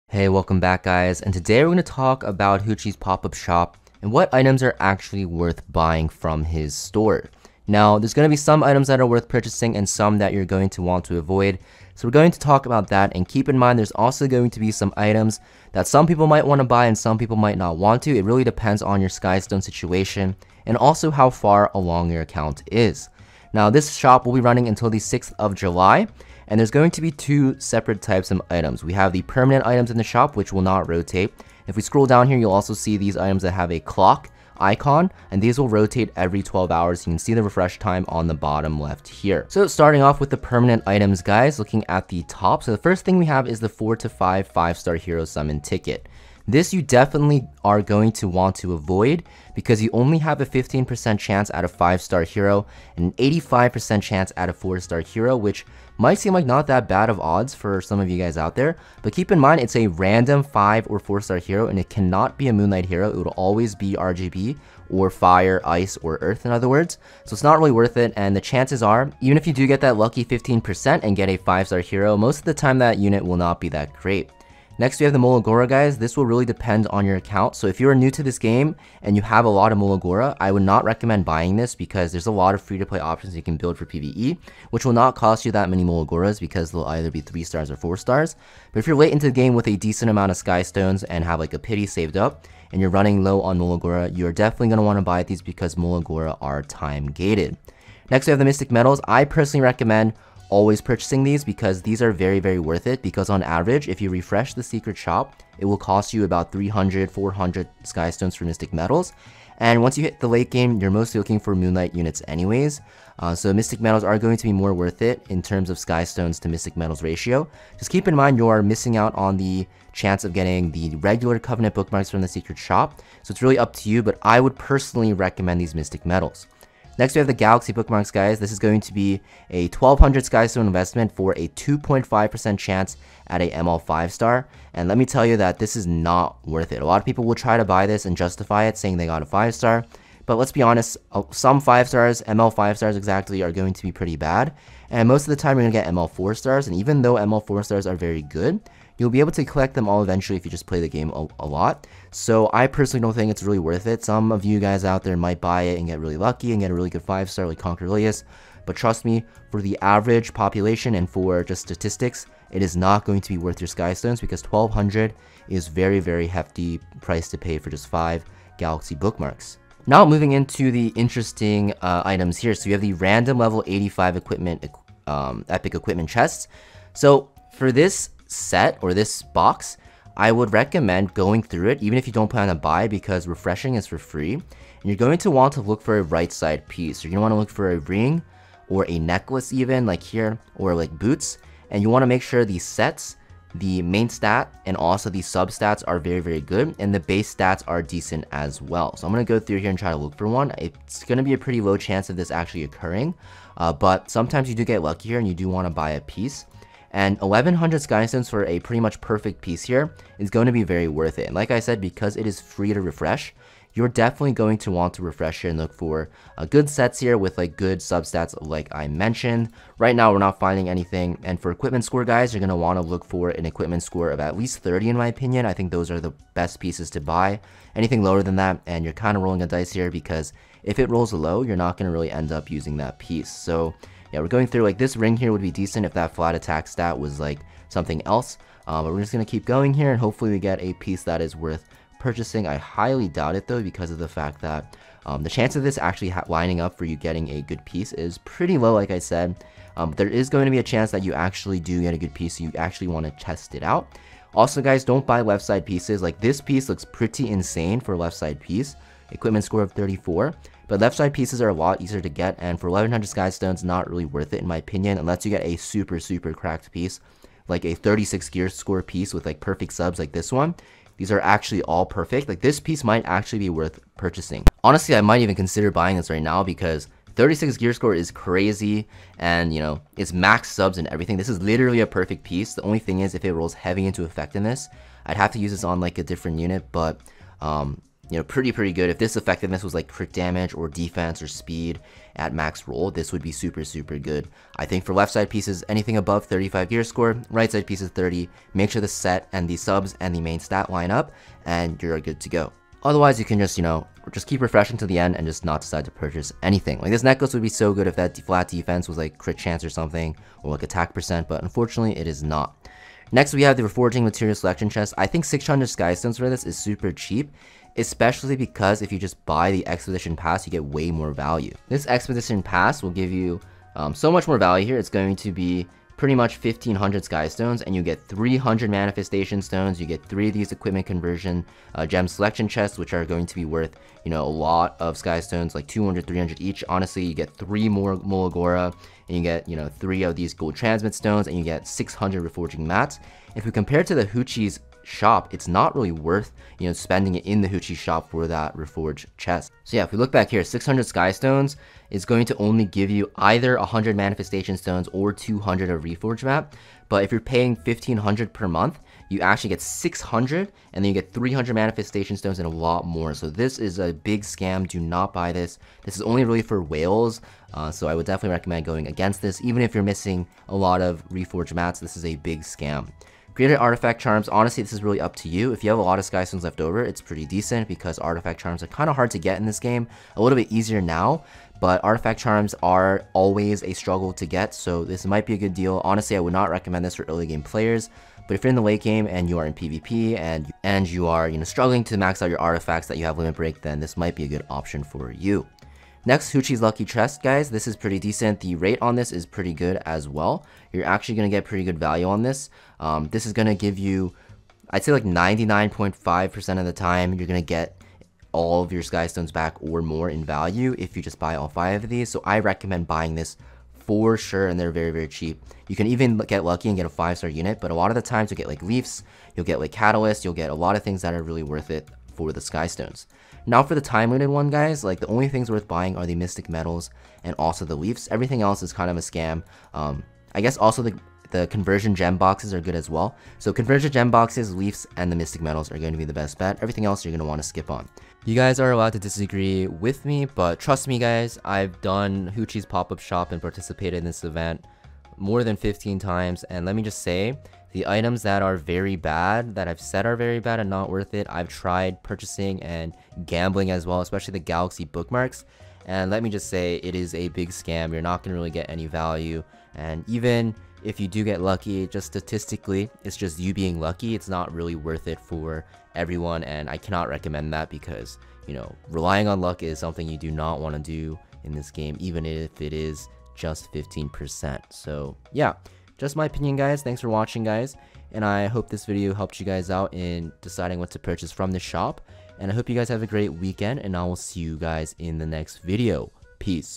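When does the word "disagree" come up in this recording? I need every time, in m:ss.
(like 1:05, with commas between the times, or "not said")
7:18.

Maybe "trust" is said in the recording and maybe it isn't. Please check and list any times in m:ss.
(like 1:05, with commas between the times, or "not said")
2:38, 7:20.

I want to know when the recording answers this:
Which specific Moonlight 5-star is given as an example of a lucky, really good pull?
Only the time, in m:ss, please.
2:37.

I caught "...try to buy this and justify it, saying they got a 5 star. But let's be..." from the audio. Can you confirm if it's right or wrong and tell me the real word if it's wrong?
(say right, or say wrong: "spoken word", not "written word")
right.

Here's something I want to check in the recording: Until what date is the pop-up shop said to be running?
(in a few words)
6th of July.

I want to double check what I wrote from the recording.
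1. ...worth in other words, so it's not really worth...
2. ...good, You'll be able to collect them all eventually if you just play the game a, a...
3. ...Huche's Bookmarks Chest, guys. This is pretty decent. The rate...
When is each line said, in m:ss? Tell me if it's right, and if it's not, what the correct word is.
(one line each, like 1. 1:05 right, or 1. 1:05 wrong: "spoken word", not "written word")
1. 1:06 wrong: "earth", not "worth"
2. 2:28 right
3. 6:36 wrong: "Lucky", not "Bookmarks".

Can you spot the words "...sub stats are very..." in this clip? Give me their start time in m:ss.
3:15.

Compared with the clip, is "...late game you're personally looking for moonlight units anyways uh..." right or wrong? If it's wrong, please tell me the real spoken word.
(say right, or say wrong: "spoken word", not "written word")
wrong: "mostly", not "personally".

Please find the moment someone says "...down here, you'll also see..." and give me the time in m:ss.
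0:32.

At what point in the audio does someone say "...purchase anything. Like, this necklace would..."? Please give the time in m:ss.
5:05.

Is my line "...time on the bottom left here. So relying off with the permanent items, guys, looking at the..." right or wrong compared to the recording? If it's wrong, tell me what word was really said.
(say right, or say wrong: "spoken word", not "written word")
wrong: "starting", not "relying".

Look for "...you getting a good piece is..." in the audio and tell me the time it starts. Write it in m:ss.
4:06.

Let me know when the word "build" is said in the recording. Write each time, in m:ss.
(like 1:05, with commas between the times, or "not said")
1:23.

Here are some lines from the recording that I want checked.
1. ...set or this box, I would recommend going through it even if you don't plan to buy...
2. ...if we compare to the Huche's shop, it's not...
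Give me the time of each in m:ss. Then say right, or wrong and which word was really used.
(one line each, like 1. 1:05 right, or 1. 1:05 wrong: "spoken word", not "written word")
1. 2:58 right
2. 5:43 right.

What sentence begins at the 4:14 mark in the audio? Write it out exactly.
Also, guys, don't buy left side pieces.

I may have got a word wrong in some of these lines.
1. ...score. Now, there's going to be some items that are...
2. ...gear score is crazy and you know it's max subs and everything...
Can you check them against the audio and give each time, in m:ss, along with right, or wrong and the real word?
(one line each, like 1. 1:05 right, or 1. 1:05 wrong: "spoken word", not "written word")
1. 0:06 wrong: "store", not "score"
2. 4:37 right.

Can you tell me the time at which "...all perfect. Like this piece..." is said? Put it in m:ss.
4:31.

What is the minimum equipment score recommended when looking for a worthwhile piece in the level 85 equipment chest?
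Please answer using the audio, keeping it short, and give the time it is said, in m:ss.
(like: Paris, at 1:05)
30, at 3:44.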